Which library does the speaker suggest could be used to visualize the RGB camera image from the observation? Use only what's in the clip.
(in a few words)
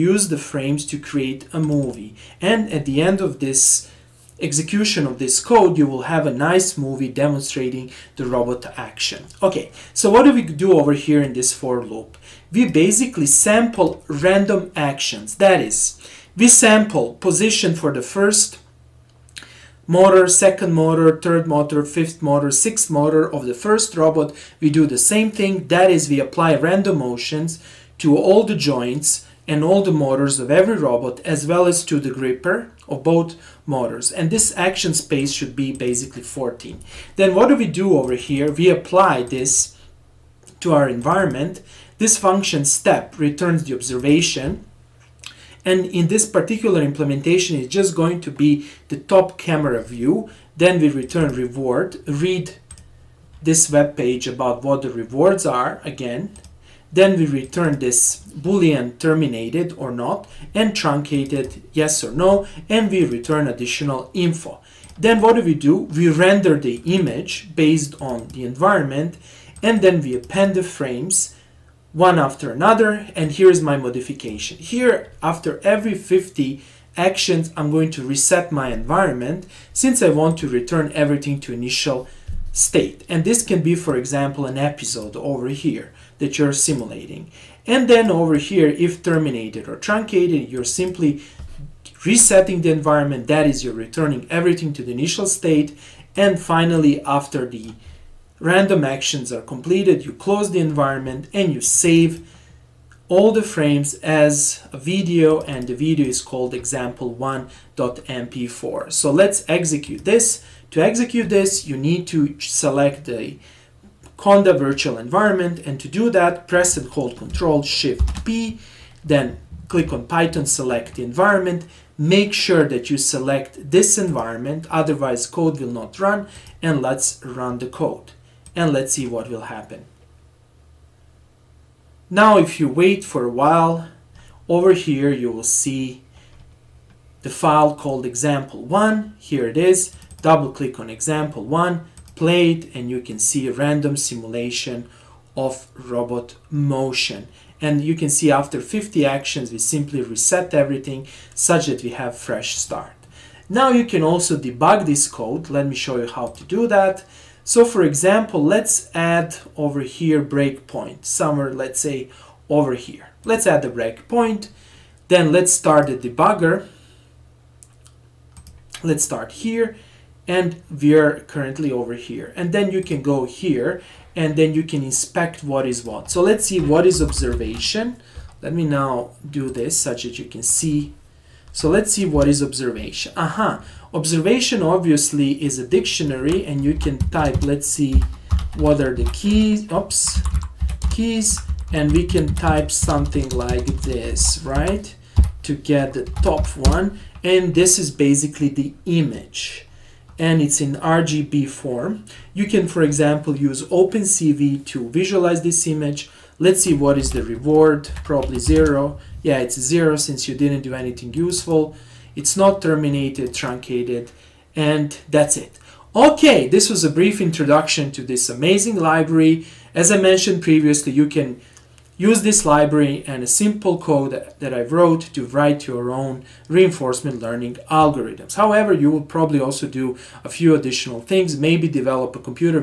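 OpenCV.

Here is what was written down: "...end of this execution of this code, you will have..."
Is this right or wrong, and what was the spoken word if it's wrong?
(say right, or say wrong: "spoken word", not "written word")
right.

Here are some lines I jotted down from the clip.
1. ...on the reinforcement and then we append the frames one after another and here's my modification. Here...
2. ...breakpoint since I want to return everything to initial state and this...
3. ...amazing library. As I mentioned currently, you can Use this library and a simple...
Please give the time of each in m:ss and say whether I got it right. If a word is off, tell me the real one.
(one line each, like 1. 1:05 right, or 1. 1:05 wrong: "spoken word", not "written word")
1. 1:08 wrong: "environment", not "reinforcement"
2. 1:18 wrong: "environment", not "breakpoint"
3. 3:38 wrong: "previously", not "currently".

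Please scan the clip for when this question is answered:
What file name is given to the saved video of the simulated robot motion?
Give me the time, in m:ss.
1:46.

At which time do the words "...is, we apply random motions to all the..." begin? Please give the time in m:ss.
0:25.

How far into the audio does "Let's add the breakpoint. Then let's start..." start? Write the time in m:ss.
2:43.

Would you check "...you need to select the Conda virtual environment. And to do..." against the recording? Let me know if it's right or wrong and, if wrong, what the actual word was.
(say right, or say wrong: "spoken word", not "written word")
right.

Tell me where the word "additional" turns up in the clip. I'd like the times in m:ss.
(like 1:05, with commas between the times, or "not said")
1:03, 3:50.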